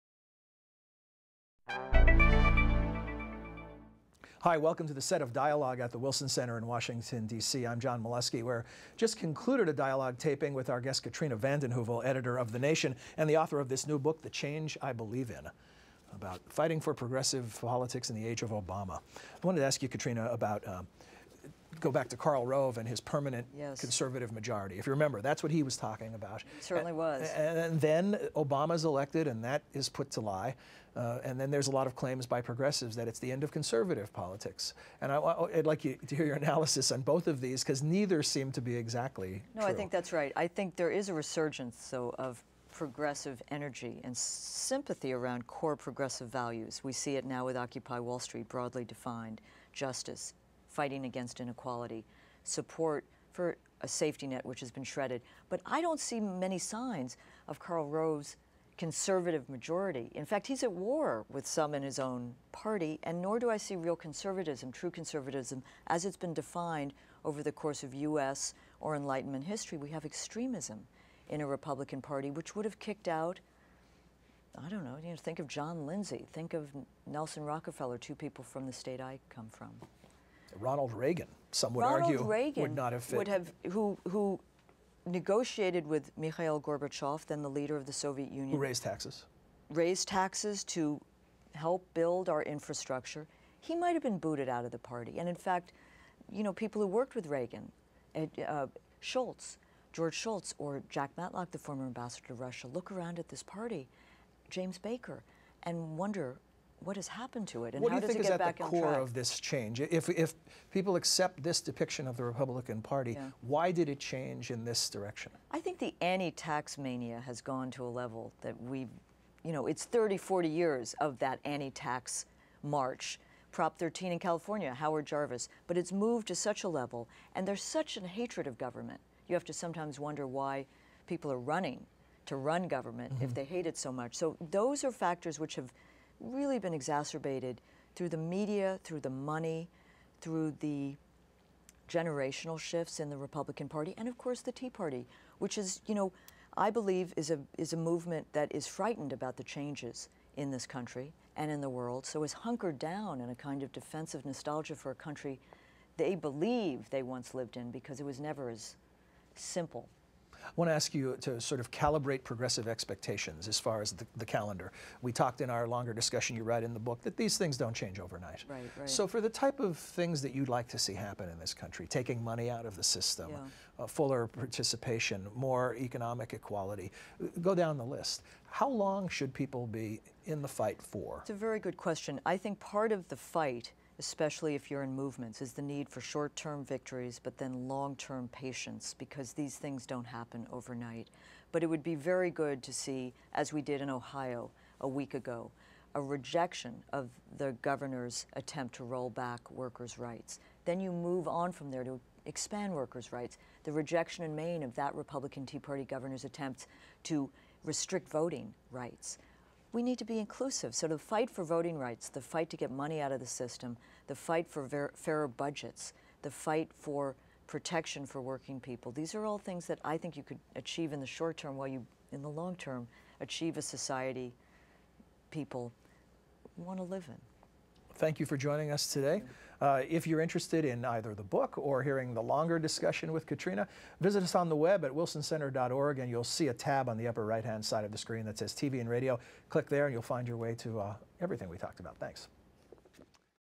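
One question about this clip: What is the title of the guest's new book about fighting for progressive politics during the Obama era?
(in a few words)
The Change I Believe In.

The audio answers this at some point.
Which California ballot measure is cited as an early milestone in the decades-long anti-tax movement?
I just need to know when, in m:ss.
2:03.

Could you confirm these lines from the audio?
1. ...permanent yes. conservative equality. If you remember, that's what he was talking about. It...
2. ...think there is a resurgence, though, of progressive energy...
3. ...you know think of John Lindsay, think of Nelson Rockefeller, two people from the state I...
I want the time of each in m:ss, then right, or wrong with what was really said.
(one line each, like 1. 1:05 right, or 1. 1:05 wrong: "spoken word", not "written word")
1. 0:23 wrong: "majority", not "equality"
2. 0:40 right
3. 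1:15 right.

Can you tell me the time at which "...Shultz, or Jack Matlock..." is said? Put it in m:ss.
1:40.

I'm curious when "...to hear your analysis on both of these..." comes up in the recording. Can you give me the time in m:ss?
0:36.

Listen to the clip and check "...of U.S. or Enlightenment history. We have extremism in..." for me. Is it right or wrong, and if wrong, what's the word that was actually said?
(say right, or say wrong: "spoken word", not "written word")
right.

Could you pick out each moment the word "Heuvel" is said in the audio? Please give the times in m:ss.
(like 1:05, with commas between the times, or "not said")
0:11.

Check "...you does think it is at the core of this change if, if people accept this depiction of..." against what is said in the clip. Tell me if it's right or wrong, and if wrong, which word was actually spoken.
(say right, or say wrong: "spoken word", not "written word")
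right.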